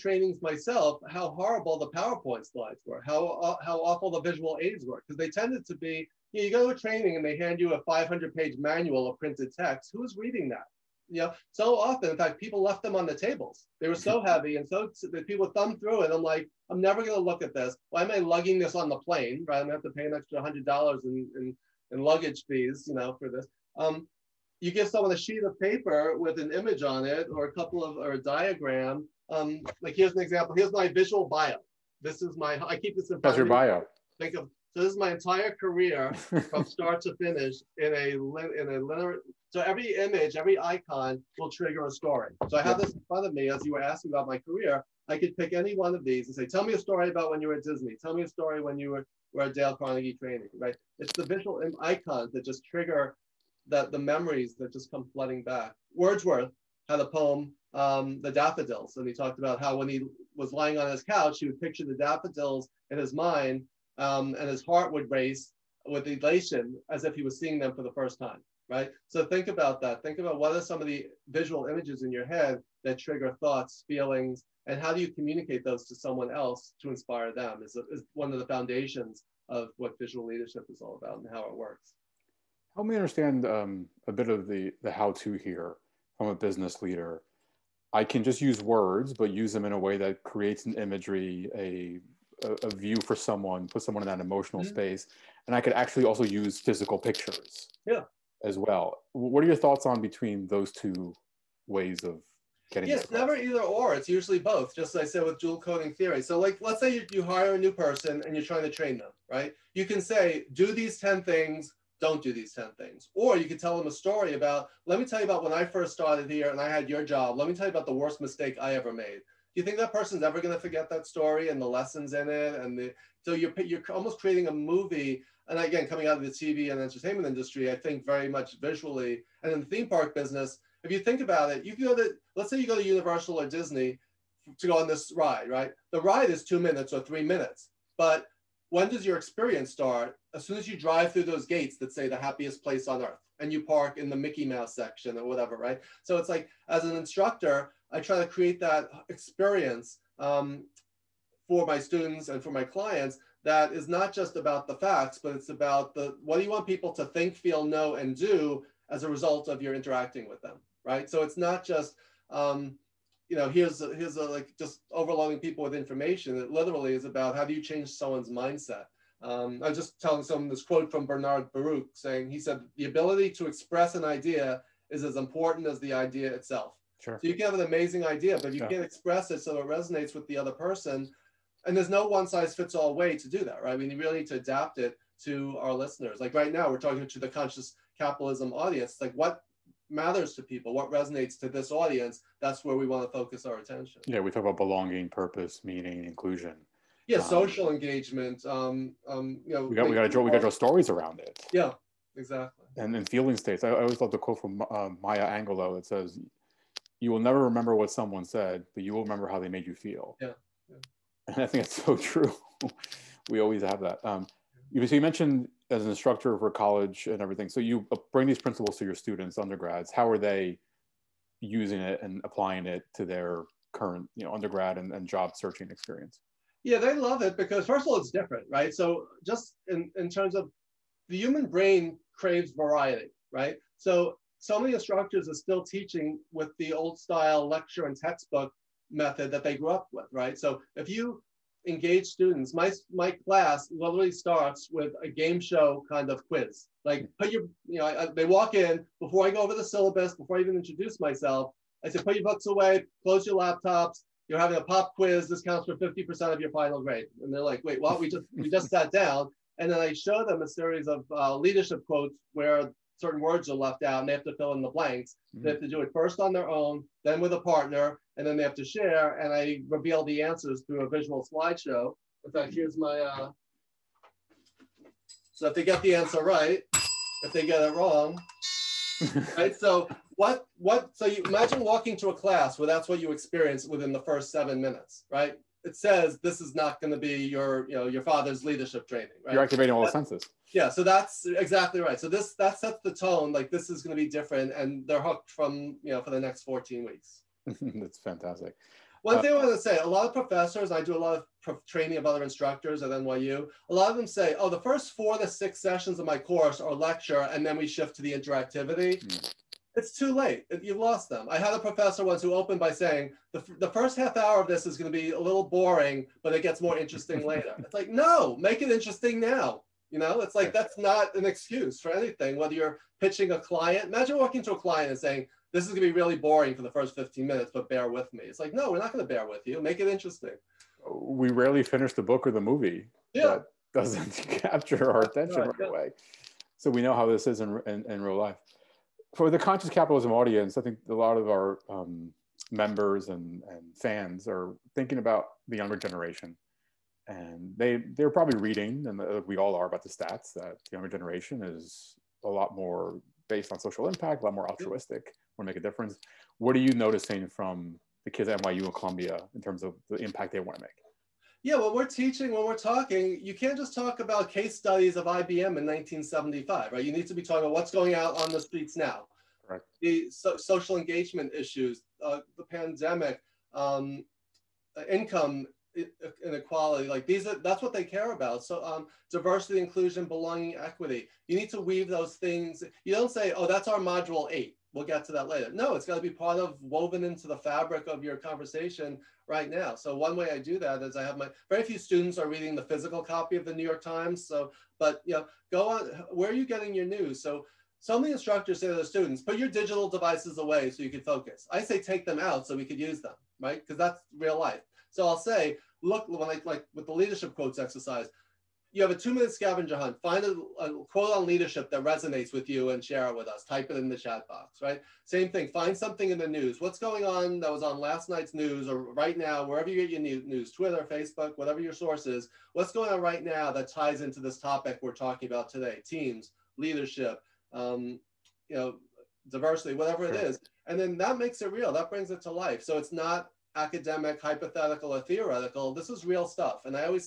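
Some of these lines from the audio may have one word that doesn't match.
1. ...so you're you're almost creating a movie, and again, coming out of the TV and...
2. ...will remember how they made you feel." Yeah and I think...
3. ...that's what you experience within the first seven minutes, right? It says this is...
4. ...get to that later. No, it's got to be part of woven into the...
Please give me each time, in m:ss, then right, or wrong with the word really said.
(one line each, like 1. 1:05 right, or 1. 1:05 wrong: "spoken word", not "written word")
1. 2:03 right
2. 3:28 right
3. 4:42 right
4. 6:24 right.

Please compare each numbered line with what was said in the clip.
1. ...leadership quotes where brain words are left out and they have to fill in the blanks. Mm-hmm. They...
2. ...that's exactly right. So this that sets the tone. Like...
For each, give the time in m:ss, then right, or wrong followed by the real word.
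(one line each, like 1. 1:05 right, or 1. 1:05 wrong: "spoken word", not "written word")
1. 4:21 wrong: "certain", not "brain"
2. 4:50 right.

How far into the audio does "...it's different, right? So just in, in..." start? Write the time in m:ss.
3:47.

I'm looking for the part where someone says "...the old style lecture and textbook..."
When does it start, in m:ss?
3:56.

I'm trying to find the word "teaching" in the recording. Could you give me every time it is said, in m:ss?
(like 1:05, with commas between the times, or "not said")
3:55, 6:01.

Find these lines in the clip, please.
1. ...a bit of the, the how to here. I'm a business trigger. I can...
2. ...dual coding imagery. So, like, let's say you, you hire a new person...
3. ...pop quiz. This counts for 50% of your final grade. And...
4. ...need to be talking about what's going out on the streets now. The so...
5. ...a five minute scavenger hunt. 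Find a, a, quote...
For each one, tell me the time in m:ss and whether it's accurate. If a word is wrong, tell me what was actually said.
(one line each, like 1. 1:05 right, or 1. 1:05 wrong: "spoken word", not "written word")
1. 1:24 wrong: "leader", not "trigger"
2. 1:45 wrong: "theory", not "imagery"
3. 4:14 right
4. 6:06 right
5. 6:48 wrong: "two", not "five".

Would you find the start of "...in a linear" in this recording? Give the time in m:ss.
0:38.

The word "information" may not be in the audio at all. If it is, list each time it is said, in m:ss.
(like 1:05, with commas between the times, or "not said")
2:45.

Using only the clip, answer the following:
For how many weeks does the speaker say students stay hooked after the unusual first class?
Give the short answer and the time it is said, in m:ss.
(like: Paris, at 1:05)
14, at 4:56.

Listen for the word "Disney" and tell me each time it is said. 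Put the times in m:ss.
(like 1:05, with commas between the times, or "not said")
0:47, 2:13.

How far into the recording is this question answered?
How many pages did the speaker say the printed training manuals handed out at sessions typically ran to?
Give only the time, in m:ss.
0:07.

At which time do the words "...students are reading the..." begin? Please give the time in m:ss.
6:31.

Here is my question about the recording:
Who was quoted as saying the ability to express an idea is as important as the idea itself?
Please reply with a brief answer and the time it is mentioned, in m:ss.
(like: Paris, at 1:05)
Bernard Baruch, at 2:51.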